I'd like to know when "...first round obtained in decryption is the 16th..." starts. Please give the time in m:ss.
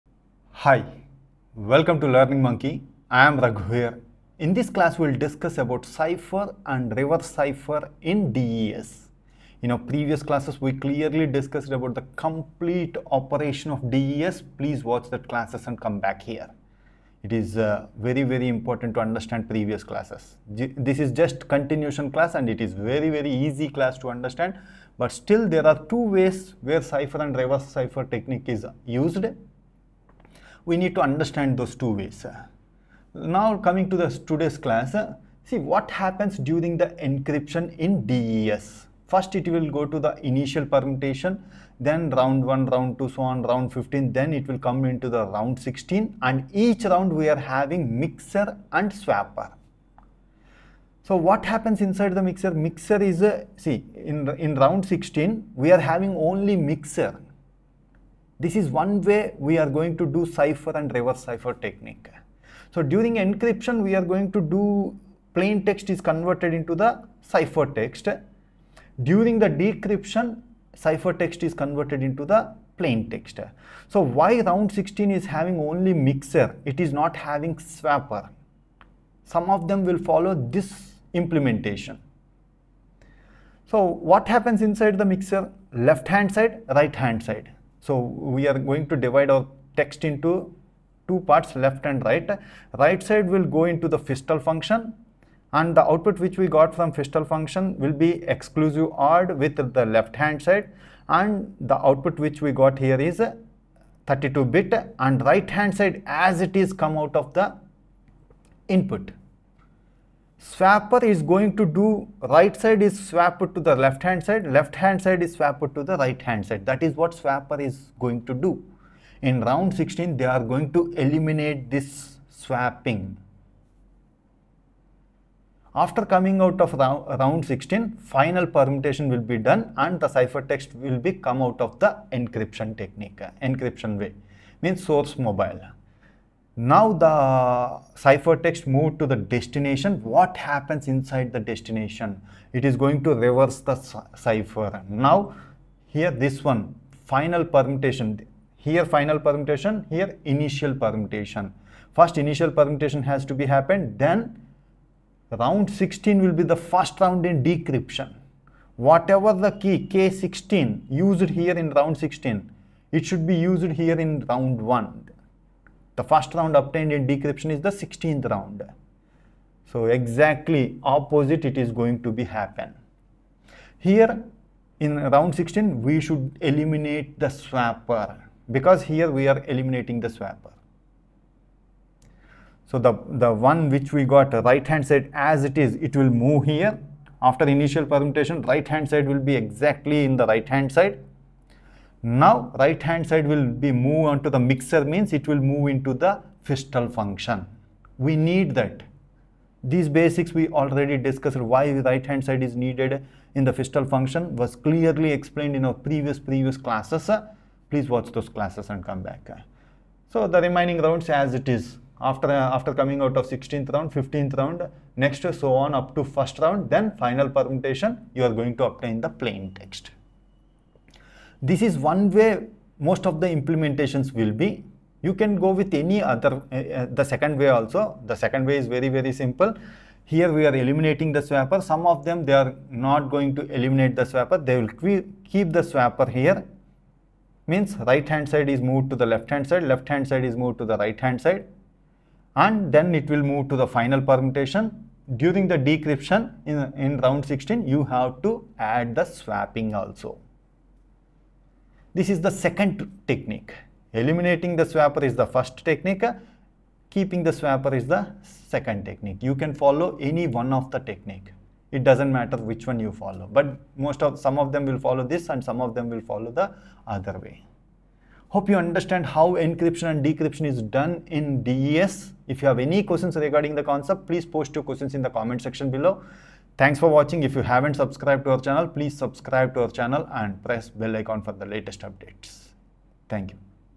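2:46.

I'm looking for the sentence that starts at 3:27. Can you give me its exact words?
Please watch those classes and come back.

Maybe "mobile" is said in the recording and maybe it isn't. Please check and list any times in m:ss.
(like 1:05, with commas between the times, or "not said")
2:15.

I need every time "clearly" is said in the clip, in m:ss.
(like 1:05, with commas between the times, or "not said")
0:10, 3:24.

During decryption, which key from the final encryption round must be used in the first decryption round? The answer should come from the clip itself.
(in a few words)
K16.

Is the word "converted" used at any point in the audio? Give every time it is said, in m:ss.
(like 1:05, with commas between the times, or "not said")
1:06, 1:11.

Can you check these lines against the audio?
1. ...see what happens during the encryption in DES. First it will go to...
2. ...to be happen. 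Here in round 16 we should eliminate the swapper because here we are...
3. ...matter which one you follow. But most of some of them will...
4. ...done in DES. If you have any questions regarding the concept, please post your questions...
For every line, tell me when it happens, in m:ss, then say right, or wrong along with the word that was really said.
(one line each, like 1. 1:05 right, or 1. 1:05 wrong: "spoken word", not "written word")
1. 0:35 right
2. 2:52 right
3. 4:22 right
4. 4:30 right.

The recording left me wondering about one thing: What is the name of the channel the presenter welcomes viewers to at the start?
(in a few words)
Learning Monkey.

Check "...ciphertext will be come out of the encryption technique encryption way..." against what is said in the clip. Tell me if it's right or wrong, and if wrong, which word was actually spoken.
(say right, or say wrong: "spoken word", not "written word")
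right.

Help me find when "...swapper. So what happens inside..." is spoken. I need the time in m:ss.
0:48.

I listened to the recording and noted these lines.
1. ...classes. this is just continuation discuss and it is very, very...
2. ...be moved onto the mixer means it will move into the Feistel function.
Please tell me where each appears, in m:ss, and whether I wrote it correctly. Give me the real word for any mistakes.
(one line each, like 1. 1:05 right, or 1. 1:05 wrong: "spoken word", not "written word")
1. 0:19 wrong: "class", not "discuss"
2. 3:13 right.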